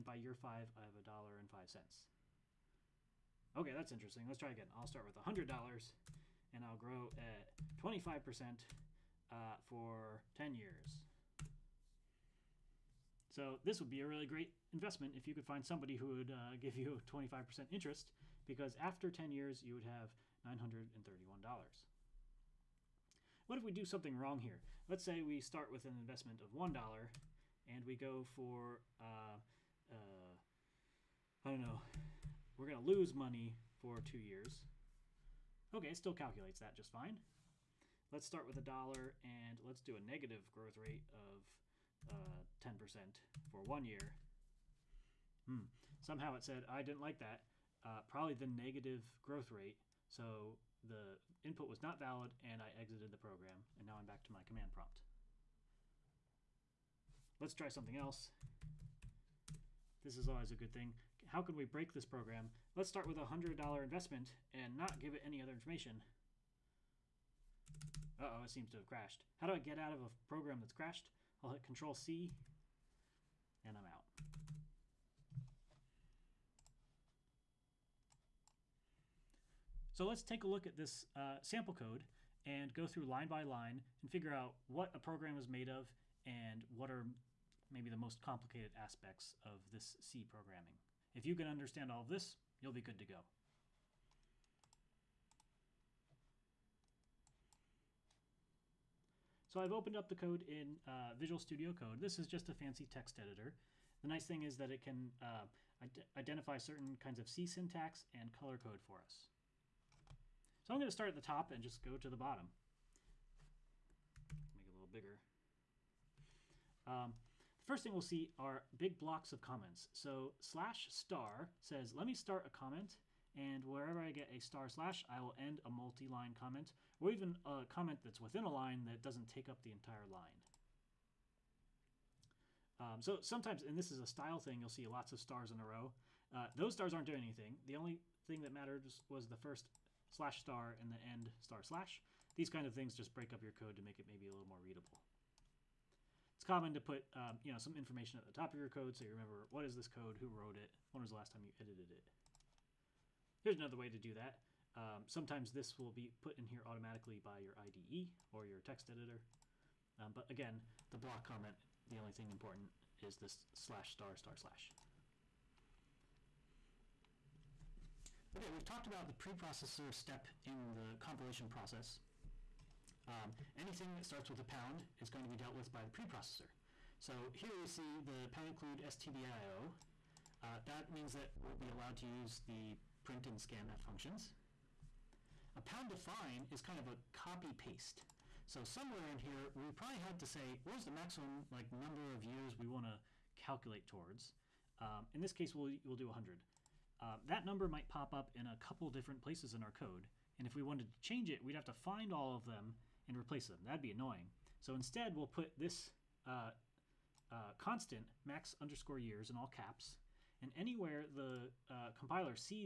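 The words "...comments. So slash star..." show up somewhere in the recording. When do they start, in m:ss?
1:59.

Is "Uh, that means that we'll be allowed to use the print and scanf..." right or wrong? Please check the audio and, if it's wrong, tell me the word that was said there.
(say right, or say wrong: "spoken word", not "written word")
right.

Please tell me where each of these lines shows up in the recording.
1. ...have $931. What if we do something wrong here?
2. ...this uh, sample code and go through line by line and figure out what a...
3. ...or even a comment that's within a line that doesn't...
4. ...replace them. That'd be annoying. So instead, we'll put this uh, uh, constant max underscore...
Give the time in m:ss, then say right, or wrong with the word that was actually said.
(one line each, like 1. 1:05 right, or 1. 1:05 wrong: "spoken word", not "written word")
1. 0:19 right
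2. 1:20 right
3. 2:06 right
4. 3:23 right.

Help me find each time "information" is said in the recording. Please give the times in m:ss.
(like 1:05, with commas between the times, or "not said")
1:05, 2:27.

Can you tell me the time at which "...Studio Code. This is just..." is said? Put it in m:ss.
1:41.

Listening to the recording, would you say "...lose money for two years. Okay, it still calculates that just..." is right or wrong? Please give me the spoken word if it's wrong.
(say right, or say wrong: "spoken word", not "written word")
right.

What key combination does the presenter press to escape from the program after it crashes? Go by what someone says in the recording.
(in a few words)
Control C.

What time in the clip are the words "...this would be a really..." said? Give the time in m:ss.
0:13.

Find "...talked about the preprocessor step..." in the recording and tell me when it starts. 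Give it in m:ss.
2:48.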